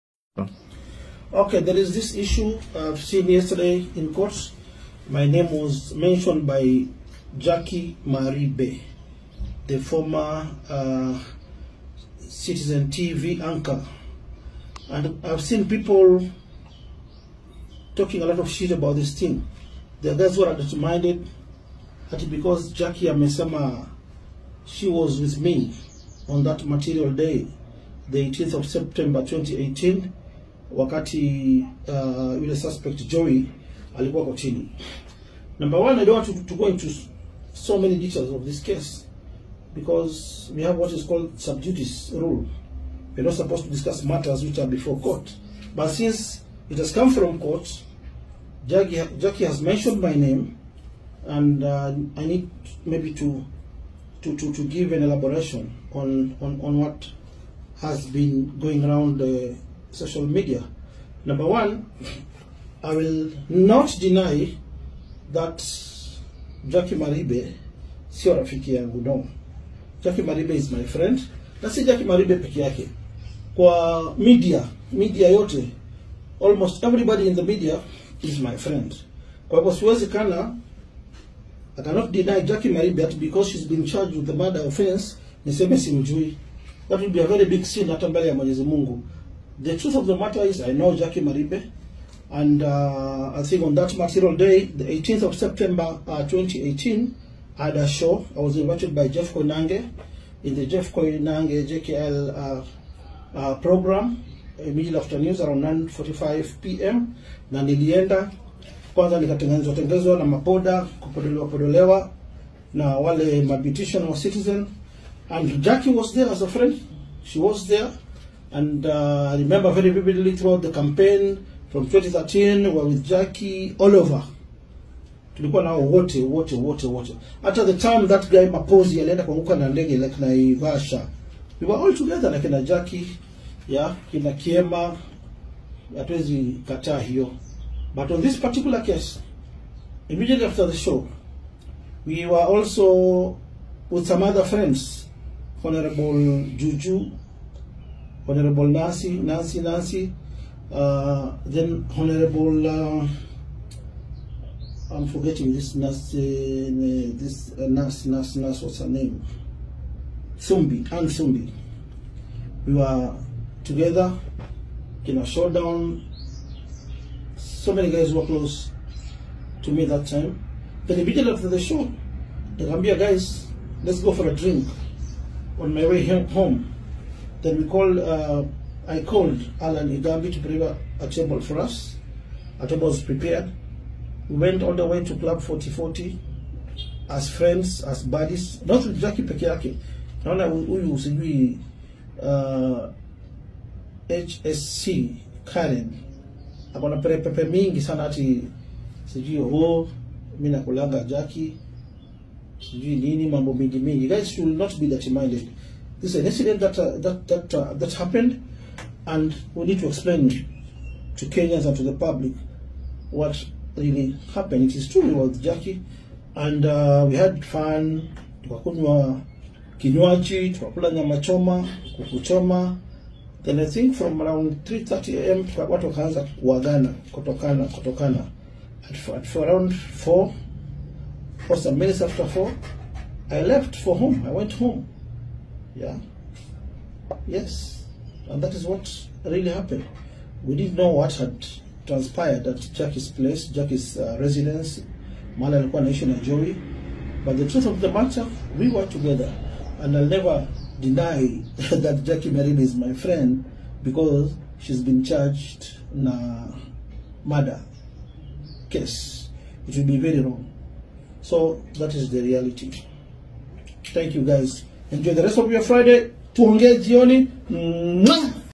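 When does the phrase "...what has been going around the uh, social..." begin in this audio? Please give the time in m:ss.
0:56.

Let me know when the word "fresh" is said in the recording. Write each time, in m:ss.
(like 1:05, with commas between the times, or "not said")
not said.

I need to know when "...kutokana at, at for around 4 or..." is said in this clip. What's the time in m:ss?
3:47.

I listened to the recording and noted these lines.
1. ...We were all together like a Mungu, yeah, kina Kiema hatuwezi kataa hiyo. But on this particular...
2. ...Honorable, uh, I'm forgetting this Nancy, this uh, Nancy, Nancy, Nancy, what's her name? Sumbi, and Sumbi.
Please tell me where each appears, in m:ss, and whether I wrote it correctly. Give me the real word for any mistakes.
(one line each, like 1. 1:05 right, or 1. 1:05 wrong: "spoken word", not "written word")
1. 2:11 wrong: "Jackie", not "Mungu"
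2. 2:31 right.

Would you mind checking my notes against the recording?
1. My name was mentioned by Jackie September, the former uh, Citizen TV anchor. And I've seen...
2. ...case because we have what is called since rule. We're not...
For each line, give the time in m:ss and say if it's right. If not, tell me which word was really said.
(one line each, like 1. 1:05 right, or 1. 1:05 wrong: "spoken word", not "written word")
1. 0:05 wrong: "Bay", not "September"
2. 0:38 wrong: "subjudice", not "since".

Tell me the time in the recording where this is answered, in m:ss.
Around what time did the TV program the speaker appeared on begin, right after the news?
1:45.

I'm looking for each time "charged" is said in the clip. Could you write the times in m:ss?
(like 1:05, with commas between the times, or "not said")
1:23, 4:15.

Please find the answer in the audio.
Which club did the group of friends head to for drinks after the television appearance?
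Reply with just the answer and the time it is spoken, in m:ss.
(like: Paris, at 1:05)
Club 4040, at 3:05.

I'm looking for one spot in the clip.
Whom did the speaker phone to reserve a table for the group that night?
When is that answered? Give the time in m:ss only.
2:59.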